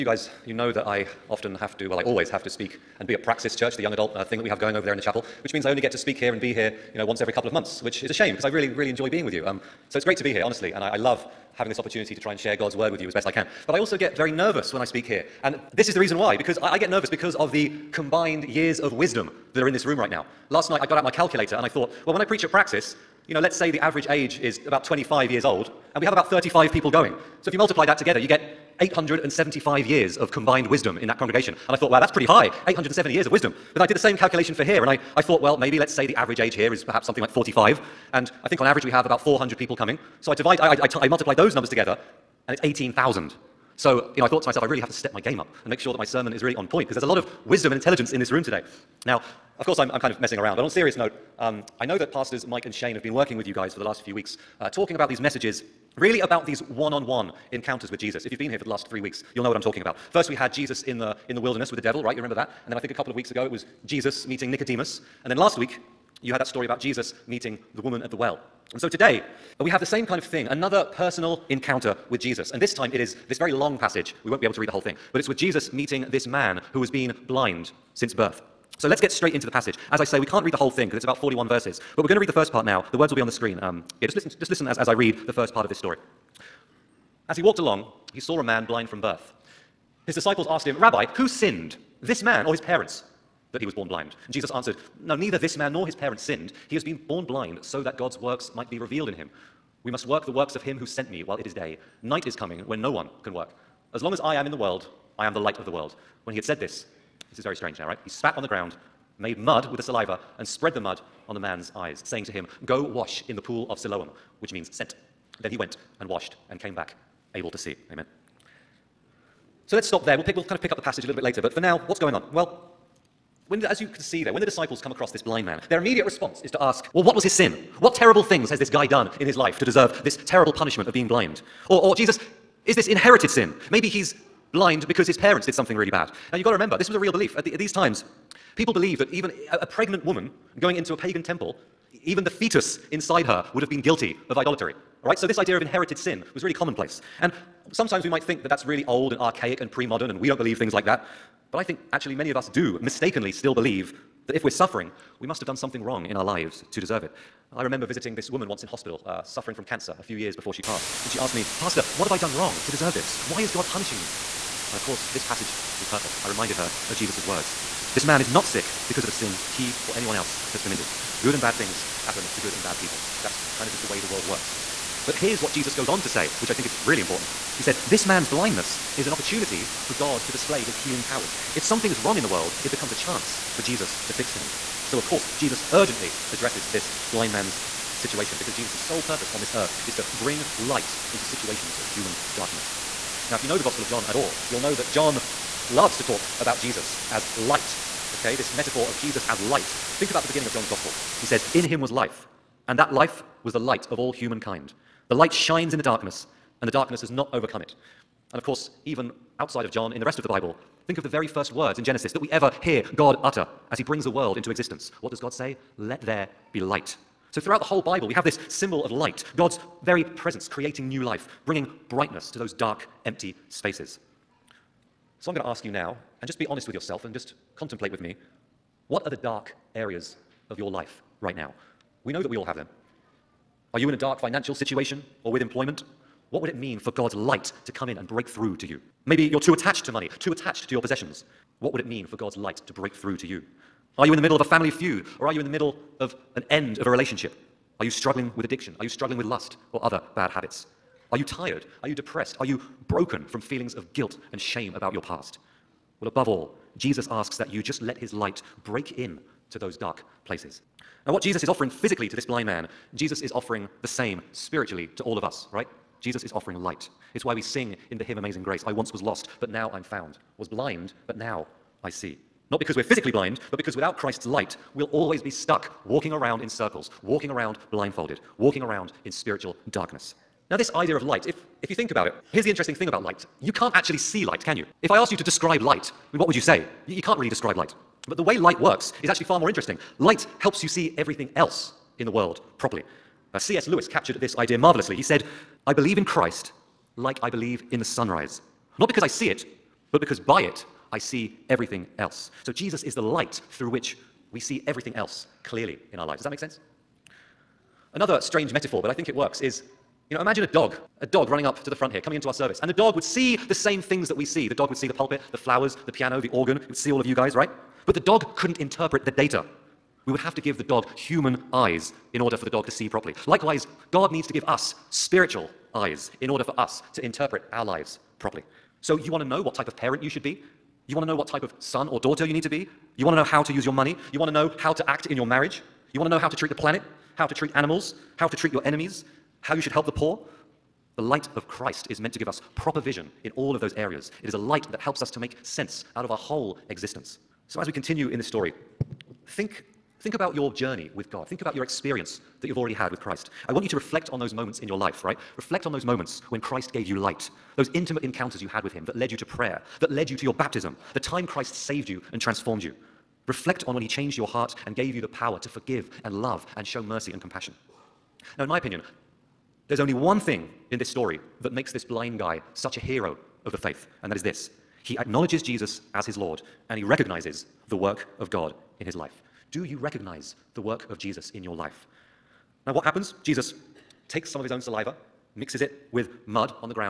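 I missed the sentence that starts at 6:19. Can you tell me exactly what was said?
Do you recognize the work of Jesus in your life?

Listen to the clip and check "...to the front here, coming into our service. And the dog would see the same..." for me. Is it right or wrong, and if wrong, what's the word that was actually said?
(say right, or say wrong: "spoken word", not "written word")
right.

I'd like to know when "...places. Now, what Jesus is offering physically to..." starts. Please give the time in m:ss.
4:20.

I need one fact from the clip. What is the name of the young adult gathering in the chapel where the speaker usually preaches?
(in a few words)
Praxis Church.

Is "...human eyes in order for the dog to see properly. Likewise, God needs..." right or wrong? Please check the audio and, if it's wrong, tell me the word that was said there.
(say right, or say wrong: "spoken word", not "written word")
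right.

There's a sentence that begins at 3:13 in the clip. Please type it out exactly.
Now, if you know the Gospel of John at all, you'll know that John loves to talk about Jesus as light.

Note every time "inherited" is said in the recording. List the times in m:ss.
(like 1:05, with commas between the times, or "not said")
2:12, 2:25.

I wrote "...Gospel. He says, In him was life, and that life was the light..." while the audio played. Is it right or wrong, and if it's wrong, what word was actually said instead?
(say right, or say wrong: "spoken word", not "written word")
right.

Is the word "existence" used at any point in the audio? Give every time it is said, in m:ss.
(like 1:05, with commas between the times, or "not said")
3:34, 5:46.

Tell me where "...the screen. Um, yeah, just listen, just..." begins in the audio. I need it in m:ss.
1:23.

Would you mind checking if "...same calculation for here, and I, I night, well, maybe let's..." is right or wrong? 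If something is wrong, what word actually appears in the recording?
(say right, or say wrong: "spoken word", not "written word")
wrong: "thought", not "night".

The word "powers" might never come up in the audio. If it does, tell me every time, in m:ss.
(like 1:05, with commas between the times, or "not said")
3:01, 6:05.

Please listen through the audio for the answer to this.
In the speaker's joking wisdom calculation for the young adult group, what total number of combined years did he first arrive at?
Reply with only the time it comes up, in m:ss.
0:28.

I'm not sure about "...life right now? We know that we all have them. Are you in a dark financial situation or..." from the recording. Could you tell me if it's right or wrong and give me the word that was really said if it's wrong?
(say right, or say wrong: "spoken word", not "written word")
right.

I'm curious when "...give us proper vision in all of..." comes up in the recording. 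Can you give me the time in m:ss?
5:42.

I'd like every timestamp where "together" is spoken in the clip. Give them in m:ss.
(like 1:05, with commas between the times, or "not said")
0:27, 0:41.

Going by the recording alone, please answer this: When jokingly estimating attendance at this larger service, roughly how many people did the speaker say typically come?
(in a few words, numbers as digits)
400.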